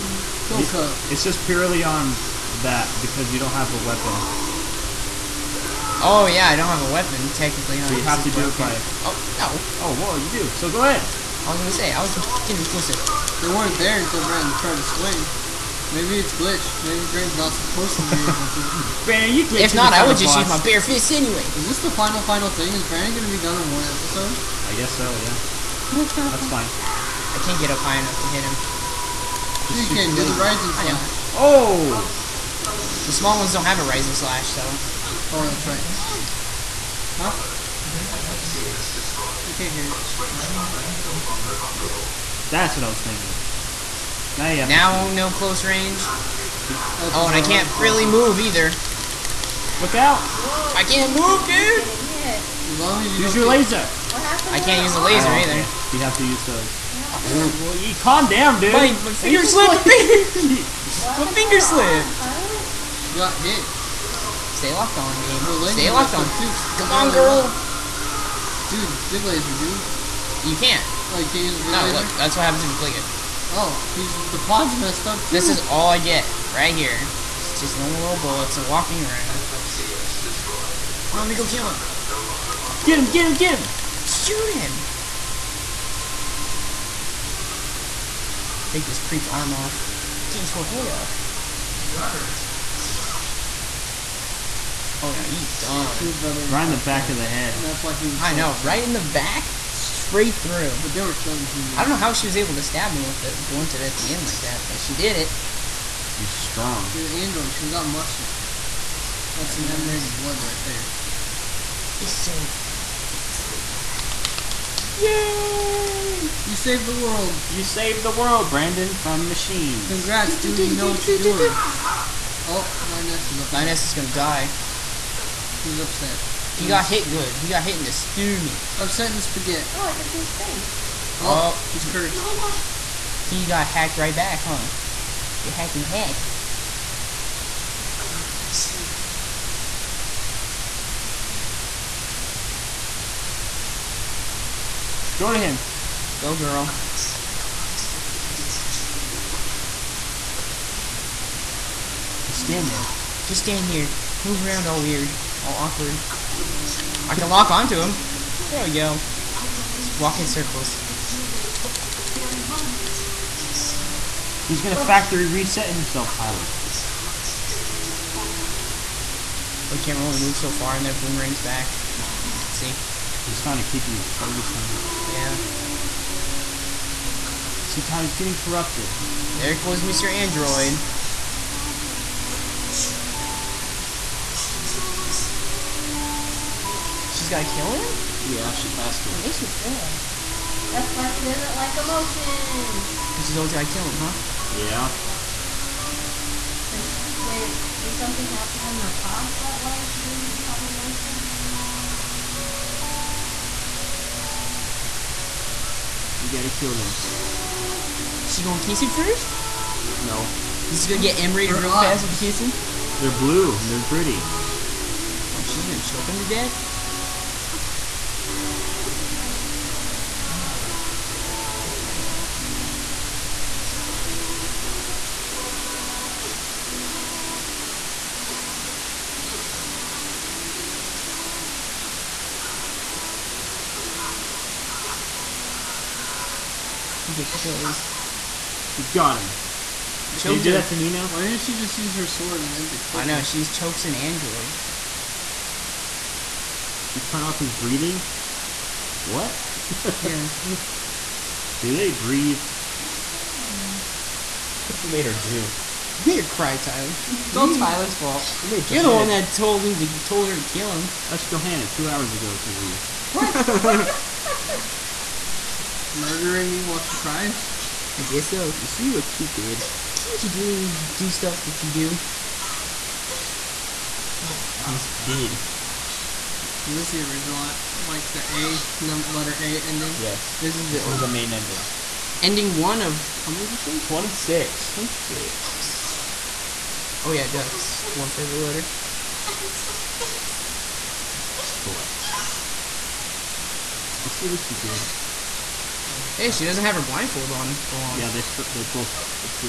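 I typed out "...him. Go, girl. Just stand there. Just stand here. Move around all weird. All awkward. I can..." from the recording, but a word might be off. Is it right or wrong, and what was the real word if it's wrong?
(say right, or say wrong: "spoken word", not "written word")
right.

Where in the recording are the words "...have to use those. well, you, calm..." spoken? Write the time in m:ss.
0:56.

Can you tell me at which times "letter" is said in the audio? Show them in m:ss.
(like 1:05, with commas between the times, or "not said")
4:39, 4:48.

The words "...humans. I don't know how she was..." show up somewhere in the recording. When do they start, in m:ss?
1:41.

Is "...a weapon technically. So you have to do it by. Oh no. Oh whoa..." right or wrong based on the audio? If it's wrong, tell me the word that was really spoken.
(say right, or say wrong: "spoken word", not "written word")
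right.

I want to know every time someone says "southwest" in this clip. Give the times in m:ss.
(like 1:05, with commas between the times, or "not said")
not said.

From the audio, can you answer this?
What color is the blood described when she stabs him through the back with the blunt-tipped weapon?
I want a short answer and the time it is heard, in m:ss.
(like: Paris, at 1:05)
Emerald, at 1:49.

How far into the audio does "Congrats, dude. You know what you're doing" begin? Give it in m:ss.
1:59.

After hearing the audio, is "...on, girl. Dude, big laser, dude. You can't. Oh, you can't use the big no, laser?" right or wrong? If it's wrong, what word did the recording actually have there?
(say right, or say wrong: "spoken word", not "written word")
right.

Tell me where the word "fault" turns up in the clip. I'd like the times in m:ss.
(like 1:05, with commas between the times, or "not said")
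4:17.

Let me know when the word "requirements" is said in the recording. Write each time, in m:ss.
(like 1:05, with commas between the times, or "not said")
not said.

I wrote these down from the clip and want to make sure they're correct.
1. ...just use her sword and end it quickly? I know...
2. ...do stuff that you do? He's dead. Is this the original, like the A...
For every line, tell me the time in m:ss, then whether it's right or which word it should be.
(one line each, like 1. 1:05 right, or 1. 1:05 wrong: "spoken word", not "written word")
1. 4:01 right
2. 4:30 right.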